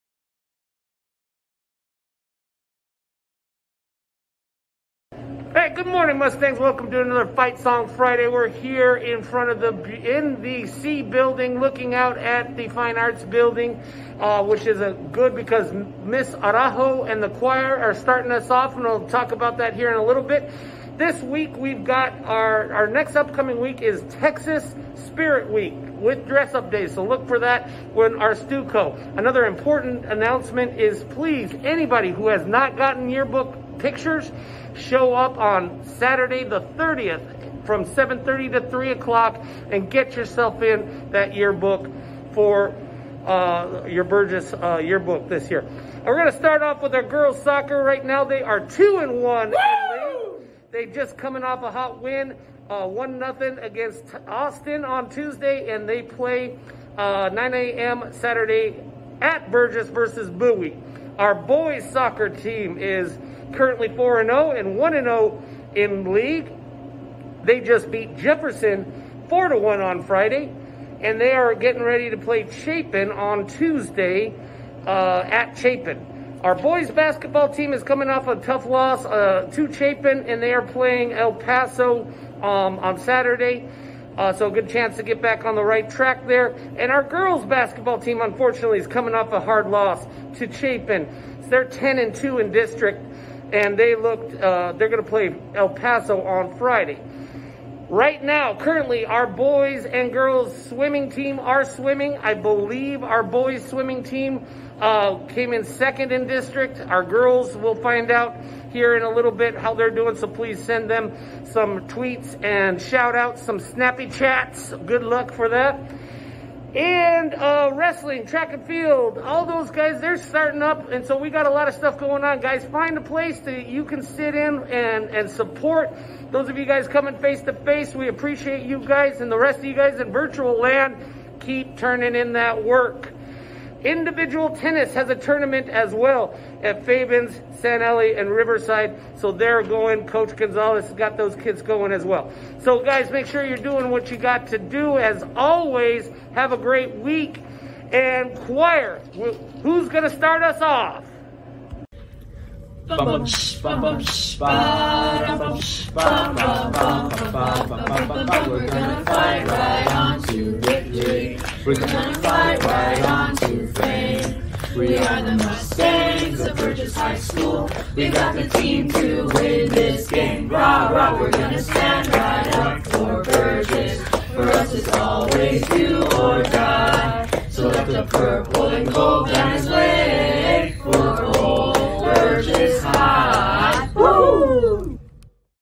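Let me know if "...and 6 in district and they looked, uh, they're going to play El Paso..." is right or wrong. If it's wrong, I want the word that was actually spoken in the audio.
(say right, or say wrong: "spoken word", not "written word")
wrong: "2", not "6".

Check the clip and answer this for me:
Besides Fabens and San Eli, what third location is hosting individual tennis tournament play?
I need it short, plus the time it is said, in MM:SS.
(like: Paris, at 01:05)
Riverside, at 02:18.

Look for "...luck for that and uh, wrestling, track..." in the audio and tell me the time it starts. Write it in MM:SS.
01:55.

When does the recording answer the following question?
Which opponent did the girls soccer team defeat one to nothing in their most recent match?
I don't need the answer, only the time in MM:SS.
00:54.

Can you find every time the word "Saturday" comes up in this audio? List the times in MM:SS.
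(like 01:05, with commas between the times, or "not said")
00:35, 00:58, 01:22.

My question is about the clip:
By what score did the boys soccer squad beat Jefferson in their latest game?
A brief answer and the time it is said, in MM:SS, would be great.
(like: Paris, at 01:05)
4 to 1, at 01:09.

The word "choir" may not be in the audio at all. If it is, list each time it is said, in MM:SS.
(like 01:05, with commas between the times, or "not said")
00:17, 02:28.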